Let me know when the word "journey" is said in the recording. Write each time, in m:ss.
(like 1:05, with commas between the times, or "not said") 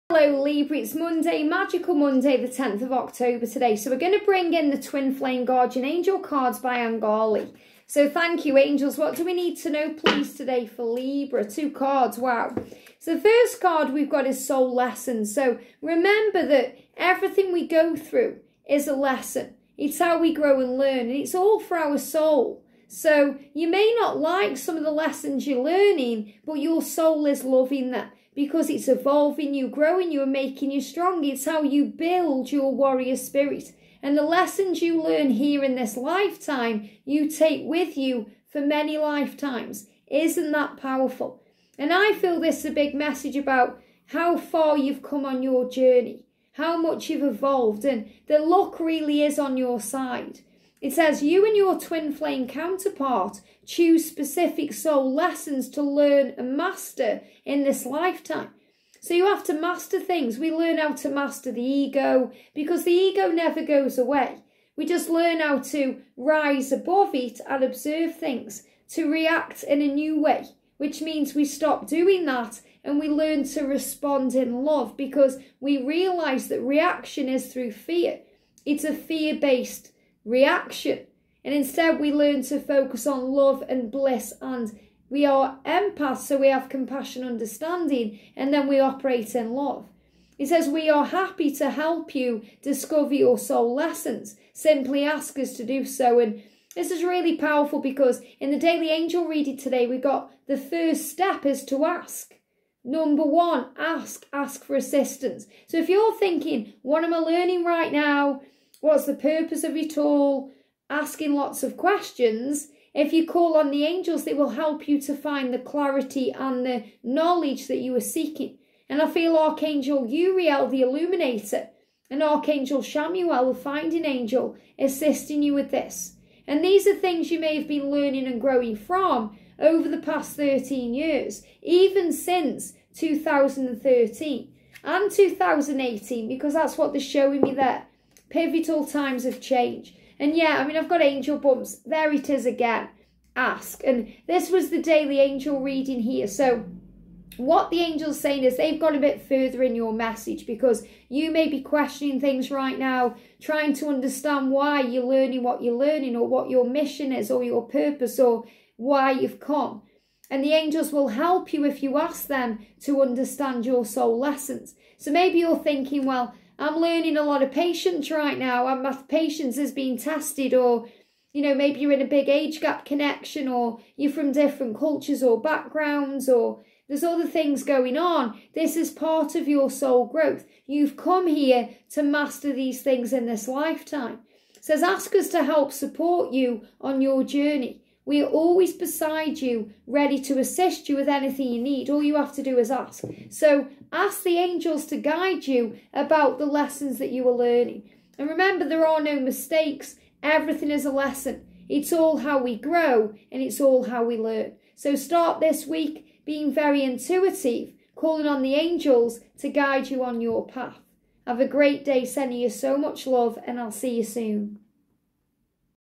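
0:45, 3:07.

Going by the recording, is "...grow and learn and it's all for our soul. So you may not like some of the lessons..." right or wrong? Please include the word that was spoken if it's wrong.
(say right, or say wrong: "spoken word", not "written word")
right.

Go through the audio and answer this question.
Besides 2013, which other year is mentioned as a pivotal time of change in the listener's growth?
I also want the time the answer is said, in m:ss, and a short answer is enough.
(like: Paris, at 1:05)
2018, at 2:15.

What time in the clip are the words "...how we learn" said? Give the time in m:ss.
3:23.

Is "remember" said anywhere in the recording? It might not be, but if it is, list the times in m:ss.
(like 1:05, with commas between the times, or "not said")
0:15, 3:18.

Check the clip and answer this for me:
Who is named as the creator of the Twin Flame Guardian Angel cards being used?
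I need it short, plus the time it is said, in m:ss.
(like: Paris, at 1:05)
Angali, at 0:06.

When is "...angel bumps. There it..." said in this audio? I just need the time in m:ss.
2:21.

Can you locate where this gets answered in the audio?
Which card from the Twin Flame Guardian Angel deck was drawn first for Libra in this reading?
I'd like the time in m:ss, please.
0:14.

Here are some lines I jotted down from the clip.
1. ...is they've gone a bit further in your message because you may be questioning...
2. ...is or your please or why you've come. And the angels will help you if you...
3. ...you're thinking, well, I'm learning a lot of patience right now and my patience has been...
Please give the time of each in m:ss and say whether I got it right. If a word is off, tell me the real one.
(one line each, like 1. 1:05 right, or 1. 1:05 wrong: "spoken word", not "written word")
1. 2:28 right
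2. 2:37 wrong: "purpose", not "please"
3. 2:45 right.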